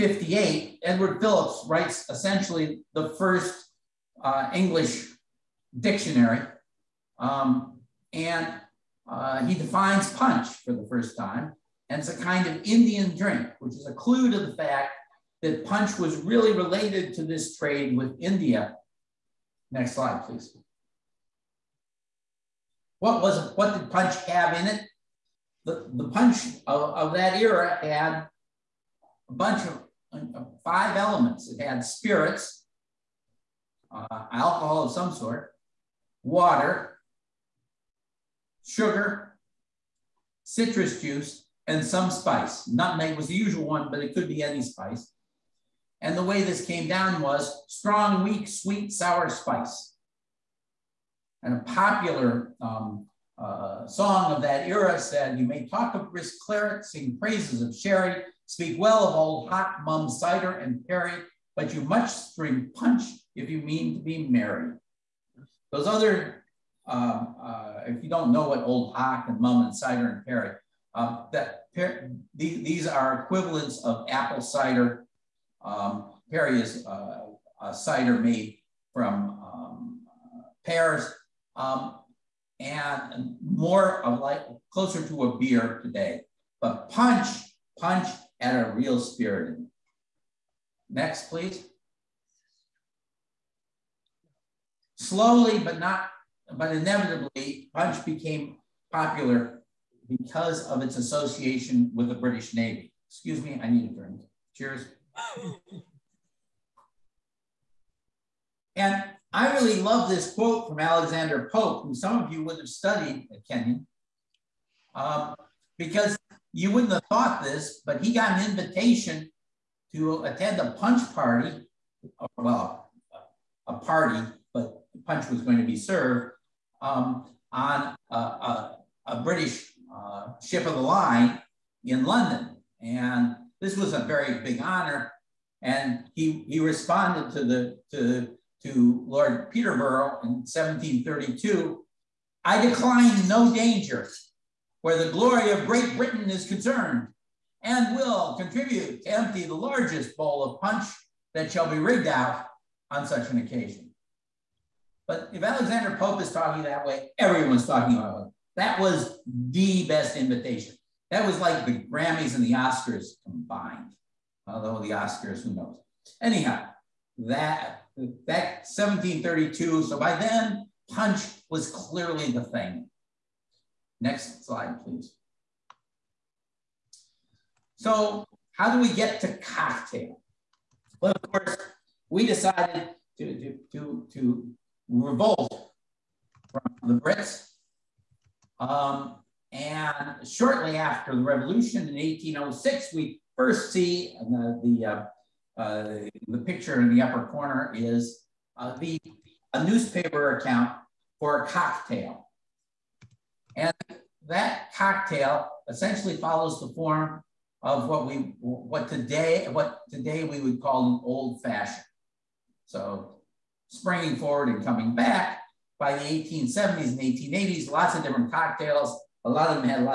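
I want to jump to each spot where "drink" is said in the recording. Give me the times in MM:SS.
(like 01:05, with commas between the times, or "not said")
00:13, 01:02, 01:43.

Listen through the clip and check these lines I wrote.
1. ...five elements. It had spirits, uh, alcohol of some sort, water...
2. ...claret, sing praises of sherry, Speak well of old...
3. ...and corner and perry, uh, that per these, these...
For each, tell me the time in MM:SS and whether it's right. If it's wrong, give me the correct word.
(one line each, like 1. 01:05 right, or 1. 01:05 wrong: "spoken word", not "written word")
1. 00:30 right
2. 00:56 right
3. 01:09 wrong: "cider", not "corner".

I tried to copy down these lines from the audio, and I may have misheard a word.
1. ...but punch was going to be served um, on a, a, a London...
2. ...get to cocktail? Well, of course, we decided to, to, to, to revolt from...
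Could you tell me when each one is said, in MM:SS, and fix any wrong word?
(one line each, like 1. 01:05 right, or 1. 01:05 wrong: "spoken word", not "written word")
1. 02:04 wrong: "British", not "London"
2. 02:58 right.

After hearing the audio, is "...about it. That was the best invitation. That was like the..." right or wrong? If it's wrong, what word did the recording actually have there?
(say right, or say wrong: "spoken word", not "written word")
right.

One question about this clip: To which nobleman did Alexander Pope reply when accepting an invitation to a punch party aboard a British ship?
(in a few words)
Lord Peterborough.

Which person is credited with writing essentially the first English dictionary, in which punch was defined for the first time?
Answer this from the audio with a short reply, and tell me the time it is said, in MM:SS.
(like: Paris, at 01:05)
Edward Phillips, at 00:00.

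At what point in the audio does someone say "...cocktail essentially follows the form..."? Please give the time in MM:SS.
03:24.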